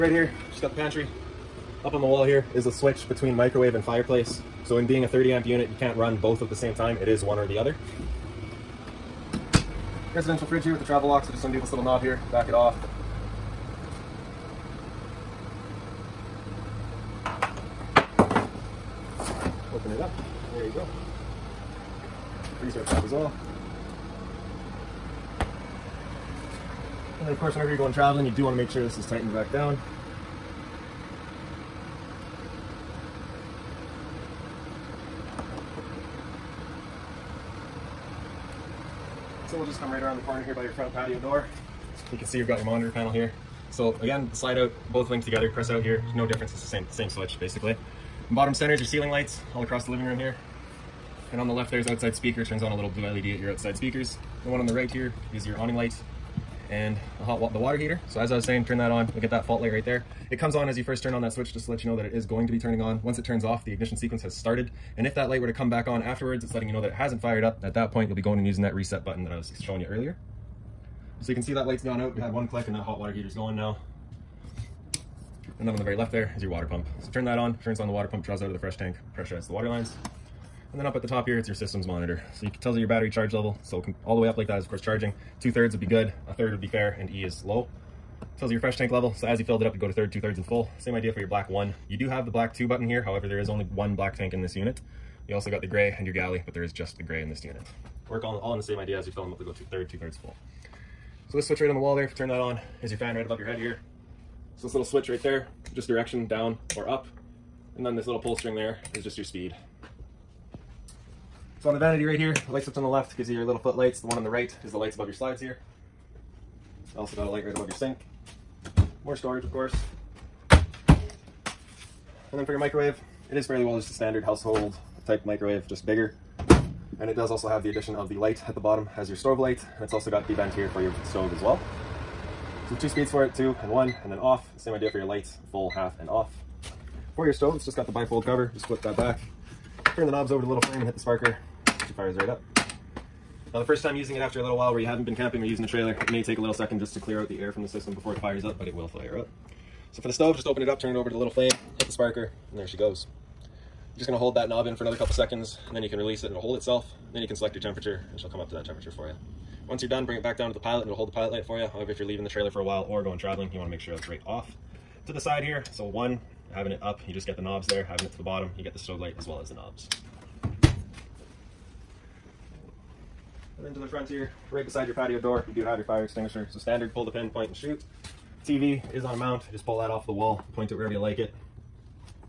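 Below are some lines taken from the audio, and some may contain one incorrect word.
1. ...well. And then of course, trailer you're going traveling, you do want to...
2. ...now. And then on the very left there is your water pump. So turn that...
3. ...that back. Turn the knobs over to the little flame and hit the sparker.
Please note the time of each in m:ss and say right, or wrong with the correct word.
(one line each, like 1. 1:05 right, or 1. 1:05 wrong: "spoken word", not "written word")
1. 0:23 wrong: "whenever", not "trailer"
2. 1:13 right
3. 2:18 right.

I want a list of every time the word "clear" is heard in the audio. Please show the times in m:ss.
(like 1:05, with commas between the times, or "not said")
2:26.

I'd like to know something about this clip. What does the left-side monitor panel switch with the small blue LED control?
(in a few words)
outside speaker.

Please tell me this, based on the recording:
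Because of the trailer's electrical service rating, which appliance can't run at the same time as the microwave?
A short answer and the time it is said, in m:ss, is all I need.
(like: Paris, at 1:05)
fireplace, at 0:03.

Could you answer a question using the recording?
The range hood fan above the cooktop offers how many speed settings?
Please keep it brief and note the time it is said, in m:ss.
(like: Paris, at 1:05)
2, at 2:12.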